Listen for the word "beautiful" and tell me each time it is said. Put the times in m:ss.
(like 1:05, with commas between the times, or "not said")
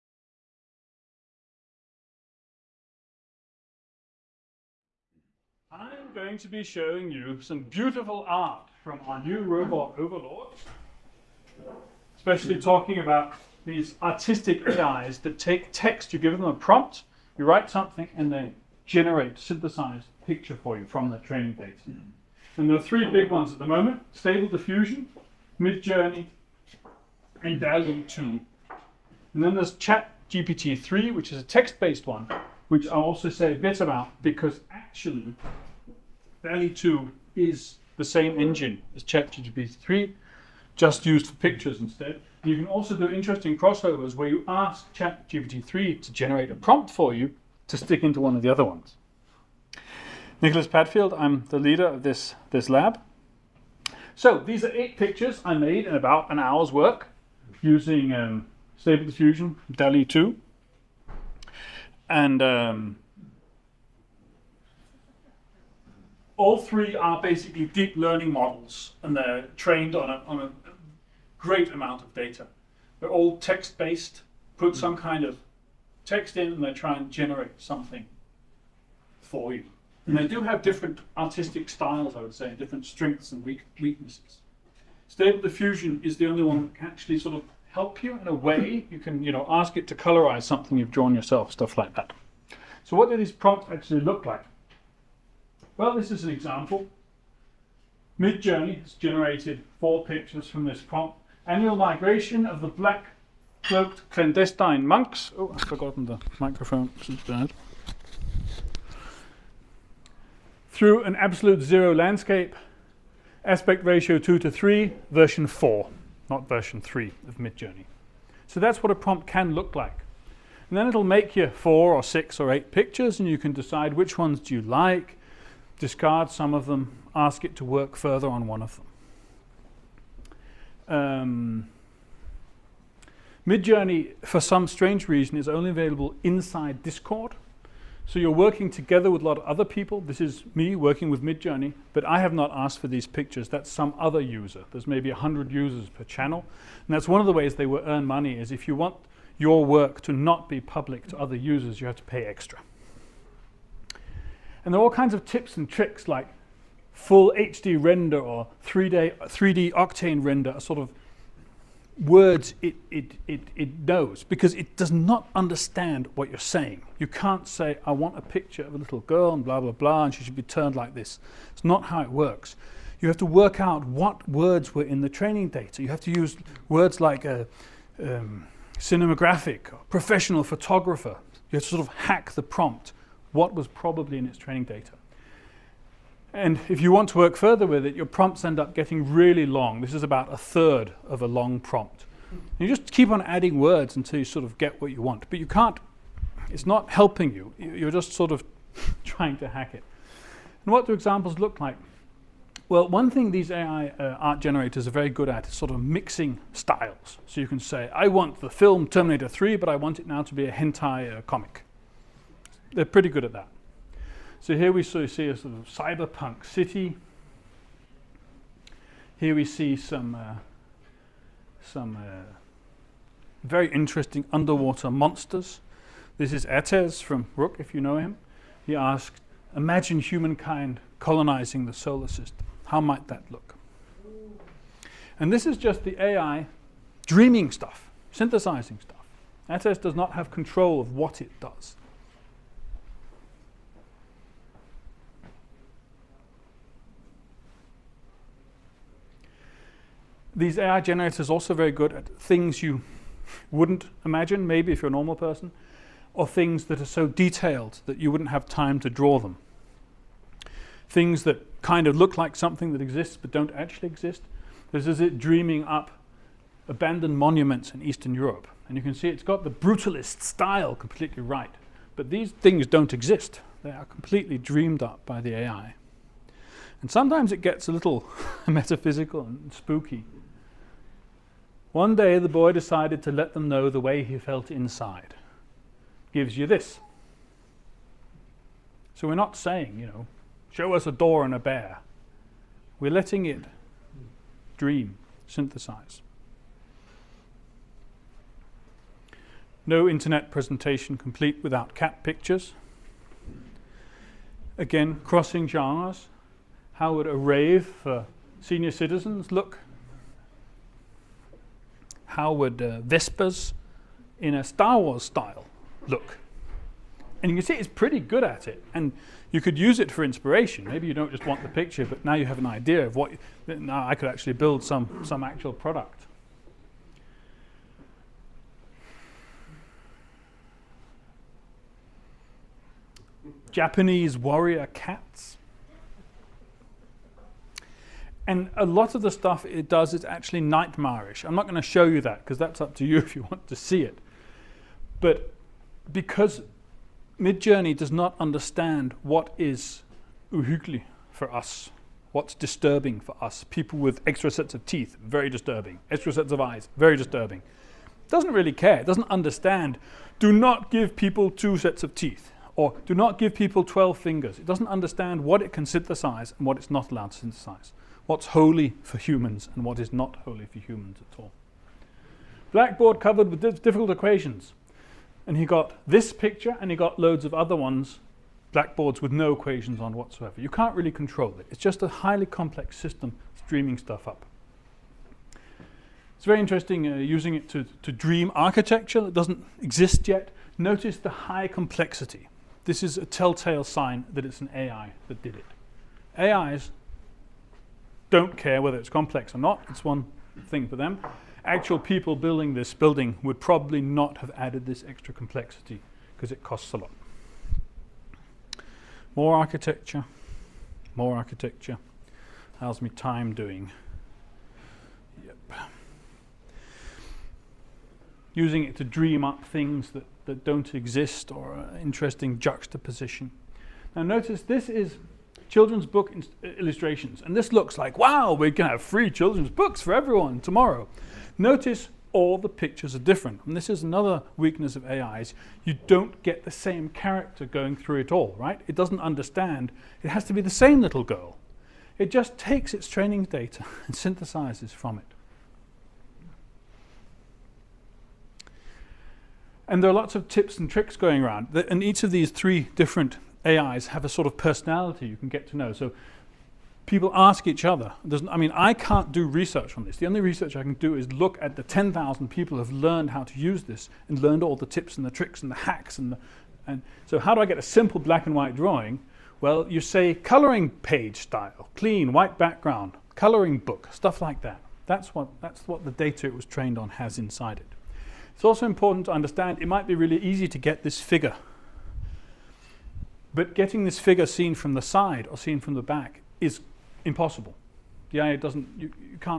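0:07.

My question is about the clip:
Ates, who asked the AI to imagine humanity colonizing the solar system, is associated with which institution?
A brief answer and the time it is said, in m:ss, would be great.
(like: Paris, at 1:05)
RUC, at 3:47.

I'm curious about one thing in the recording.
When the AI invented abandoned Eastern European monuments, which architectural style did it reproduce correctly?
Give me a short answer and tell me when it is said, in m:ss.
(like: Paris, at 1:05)
brutalist, at 4:29.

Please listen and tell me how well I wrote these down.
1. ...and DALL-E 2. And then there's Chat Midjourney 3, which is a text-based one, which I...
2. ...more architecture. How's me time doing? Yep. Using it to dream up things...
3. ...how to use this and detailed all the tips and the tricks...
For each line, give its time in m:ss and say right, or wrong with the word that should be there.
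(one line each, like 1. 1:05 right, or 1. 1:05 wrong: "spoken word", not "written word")
1. 0:27 wrong: "GPT", not "Midjourney"
2. 6:50 right
3. 7:43 wrong: "learned", not "detailed".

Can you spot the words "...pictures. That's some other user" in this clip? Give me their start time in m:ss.
2:23.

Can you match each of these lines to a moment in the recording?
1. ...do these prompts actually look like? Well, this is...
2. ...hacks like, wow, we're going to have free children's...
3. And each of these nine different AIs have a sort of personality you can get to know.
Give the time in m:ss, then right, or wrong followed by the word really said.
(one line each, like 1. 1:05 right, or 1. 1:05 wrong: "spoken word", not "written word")
1. 1:33 right
2. 7:07 wrong: "looks", not "hacks"
3. 7:31 wrong: "three", not "nine".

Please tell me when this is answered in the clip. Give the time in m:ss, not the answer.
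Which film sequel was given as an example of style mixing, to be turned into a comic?
3:28.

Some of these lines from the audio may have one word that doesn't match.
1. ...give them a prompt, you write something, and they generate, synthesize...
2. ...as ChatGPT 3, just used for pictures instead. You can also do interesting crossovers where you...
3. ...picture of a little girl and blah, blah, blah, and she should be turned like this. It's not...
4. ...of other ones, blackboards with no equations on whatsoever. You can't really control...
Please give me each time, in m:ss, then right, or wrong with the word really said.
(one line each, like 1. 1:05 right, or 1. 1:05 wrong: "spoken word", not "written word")
1. 0:16 right
2. 0:38 right
3. 2:48 right
4. 6:17 right.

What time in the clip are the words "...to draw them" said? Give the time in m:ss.
4:18.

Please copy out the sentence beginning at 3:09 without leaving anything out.
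This is about a third of a long prompt.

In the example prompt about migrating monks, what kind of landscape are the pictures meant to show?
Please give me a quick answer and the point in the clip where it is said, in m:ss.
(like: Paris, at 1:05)
absolute zero, at 1:51.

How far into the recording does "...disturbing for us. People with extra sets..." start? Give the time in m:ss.
5:52.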